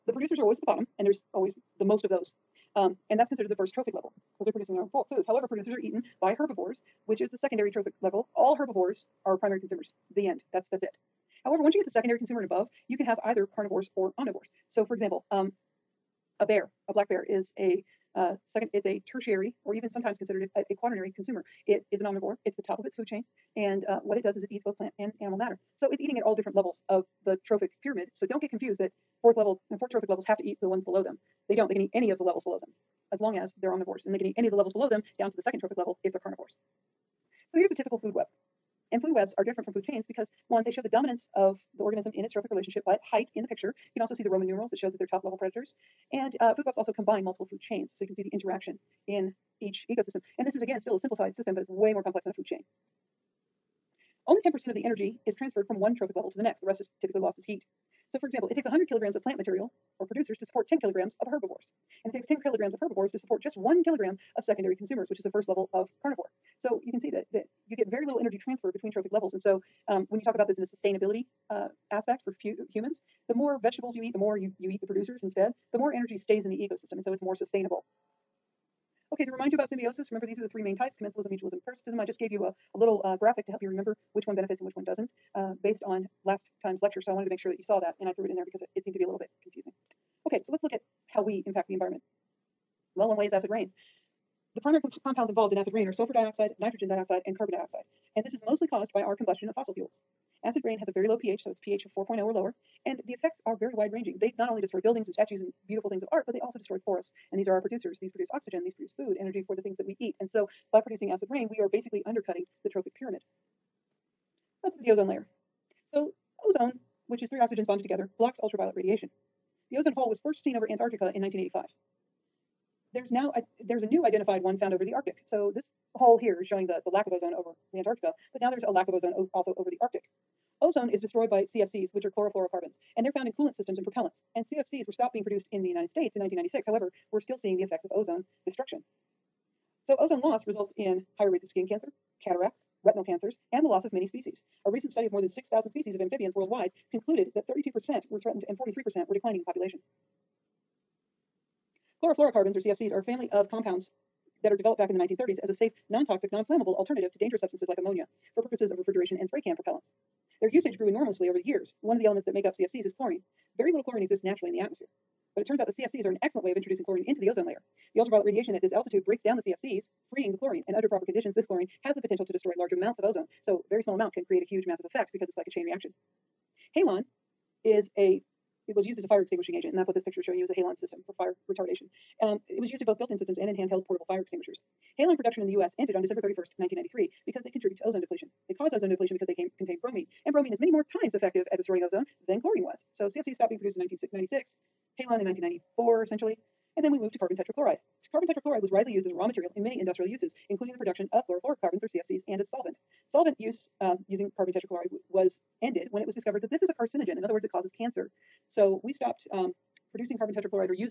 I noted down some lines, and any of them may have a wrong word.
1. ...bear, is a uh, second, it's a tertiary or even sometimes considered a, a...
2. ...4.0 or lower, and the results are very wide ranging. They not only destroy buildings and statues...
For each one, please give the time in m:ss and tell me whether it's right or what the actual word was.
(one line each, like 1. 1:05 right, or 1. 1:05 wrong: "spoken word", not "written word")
1. 0:17 right
2. 1:41 wrong: "effects", not "results".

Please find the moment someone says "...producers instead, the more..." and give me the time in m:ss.
1:14.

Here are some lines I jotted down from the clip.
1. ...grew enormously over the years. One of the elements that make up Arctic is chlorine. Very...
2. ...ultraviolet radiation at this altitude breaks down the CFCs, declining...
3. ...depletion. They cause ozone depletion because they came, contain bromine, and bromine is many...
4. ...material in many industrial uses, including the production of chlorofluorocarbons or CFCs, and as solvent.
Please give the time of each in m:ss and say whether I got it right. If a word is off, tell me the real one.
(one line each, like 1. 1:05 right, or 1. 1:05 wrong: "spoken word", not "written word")
1. 2:40 wrong: "CFCs", not "Arctic"
2. 2:47 wrong: "freeing", not "declining"
3. 3:08 right
4. 3:19 right.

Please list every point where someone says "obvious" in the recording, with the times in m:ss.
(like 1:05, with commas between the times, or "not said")
not said.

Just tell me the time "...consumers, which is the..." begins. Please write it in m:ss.
1:04.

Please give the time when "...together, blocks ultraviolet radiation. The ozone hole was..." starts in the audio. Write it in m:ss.
1:57.